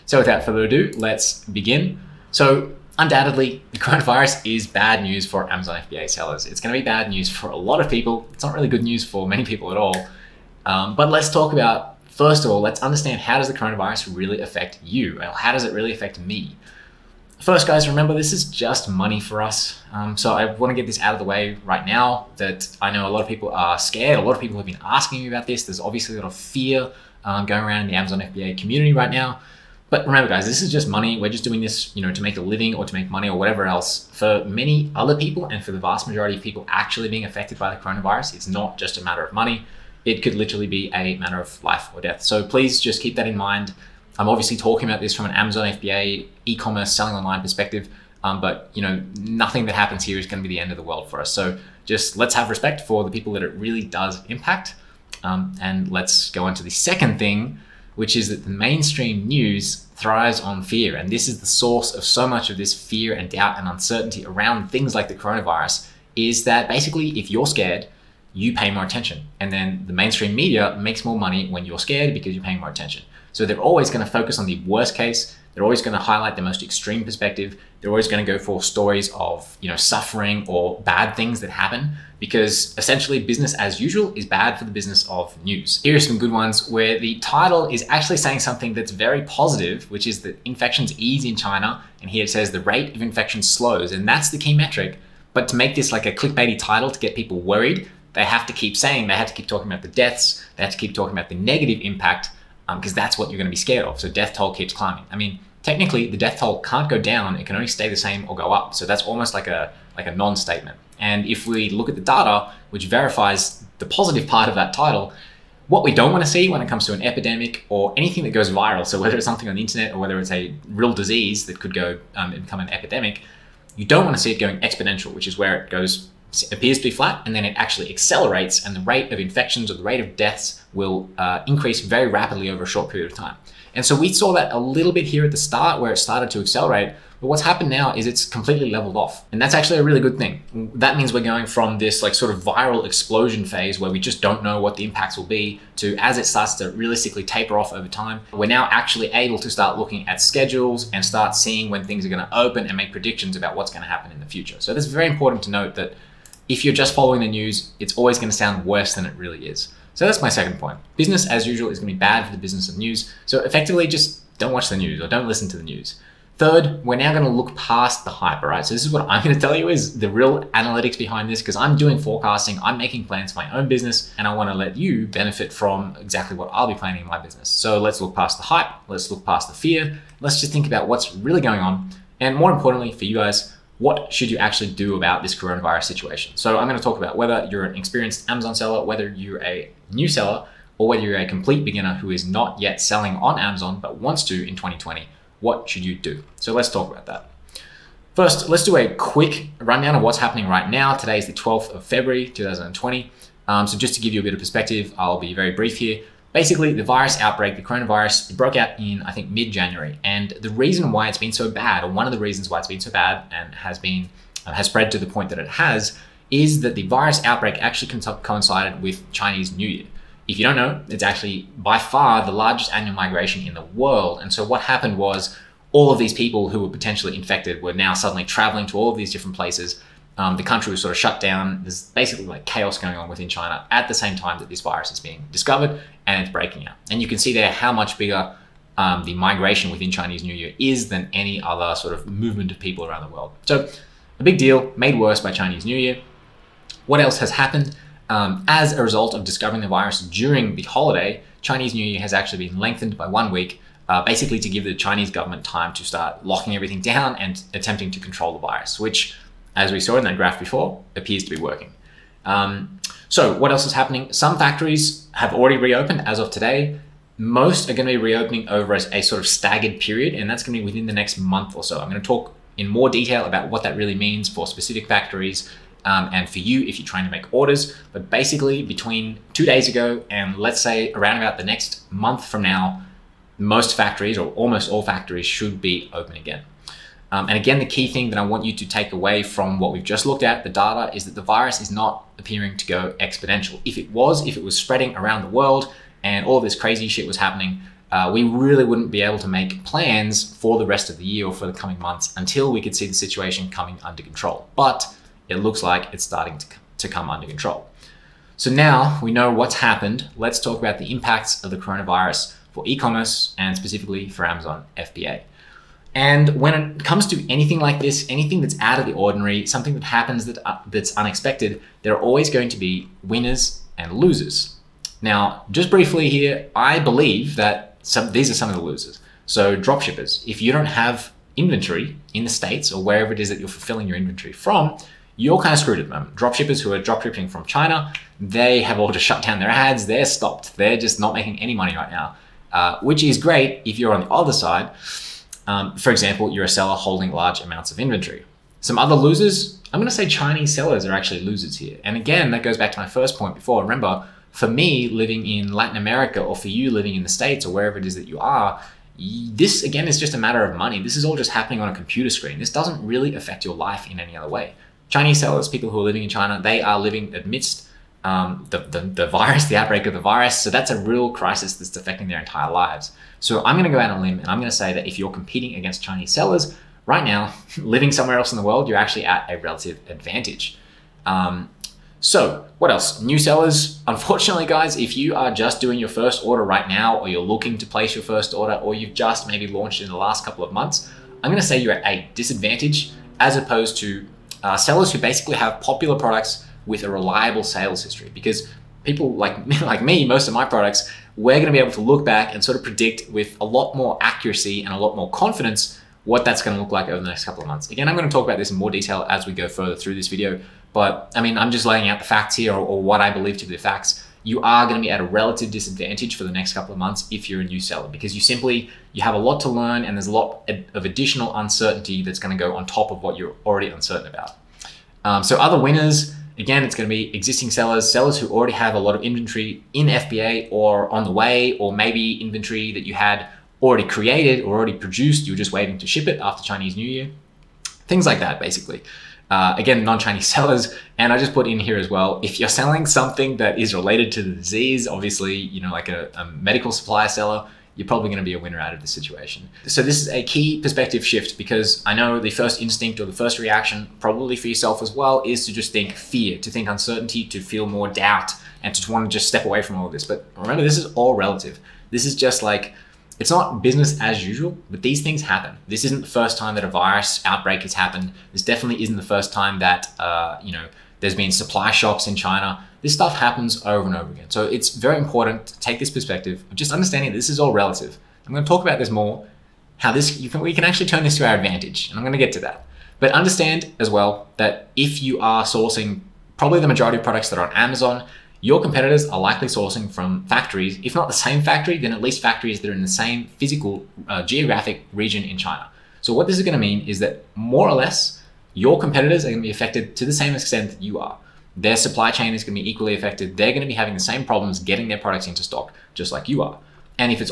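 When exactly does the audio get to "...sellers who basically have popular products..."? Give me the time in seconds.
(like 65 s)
394 s.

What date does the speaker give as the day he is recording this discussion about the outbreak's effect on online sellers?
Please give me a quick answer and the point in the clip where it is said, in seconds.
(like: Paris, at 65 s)
12th of February, 2020, at 201 s.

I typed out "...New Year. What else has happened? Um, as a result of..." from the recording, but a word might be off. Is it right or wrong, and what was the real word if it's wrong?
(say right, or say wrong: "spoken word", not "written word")
right.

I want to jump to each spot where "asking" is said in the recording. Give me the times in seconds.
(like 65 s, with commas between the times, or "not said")
24 s.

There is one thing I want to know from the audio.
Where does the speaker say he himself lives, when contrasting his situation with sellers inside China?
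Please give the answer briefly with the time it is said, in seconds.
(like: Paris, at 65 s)
Latin America, at 355 s.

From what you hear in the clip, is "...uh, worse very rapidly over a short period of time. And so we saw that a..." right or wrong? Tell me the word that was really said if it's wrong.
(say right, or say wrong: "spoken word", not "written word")
wrong: "increase", not "worse".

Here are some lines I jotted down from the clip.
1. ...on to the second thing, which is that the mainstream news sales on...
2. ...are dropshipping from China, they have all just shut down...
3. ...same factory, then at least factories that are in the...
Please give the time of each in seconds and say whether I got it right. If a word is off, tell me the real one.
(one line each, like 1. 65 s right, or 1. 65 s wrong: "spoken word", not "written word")
1. 56 s wrong: "thrives", not "sales"
2. 336 s right
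3. 491 s right.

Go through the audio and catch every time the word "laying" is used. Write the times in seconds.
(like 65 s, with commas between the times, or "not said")
411 s.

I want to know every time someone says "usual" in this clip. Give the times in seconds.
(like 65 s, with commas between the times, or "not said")
83 s, 161 s, 464 s.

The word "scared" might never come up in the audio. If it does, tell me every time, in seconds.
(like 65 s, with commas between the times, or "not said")
23 s, 67 s, 71 s, 103 s.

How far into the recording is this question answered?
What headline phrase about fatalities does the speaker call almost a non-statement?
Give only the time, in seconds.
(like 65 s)
104 s.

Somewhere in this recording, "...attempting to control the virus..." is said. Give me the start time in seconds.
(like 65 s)
257 s.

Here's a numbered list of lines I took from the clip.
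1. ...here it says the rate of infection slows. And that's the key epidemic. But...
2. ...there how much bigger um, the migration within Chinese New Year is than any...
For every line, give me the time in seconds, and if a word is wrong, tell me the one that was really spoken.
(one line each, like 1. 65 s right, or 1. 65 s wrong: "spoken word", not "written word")
1. 92 s wrong: "metric", not "epidemic"
2. 237 s right.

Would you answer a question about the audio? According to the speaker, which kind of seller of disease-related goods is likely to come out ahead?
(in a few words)
medical supply seller.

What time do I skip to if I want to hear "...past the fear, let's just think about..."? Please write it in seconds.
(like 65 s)
179 s.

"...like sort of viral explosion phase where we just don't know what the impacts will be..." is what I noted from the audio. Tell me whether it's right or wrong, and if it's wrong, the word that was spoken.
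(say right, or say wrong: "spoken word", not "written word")
right.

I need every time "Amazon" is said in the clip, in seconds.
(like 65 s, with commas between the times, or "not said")
5 s, 27 s, 45 s, 188 s, 193 s, 314 s, 487 s.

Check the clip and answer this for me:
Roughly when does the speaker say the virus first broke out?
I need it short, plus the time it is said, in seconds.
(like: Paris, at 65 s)
mid January, at 209 s.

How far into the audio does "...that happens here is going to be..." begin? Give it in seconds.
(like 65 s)
49 s.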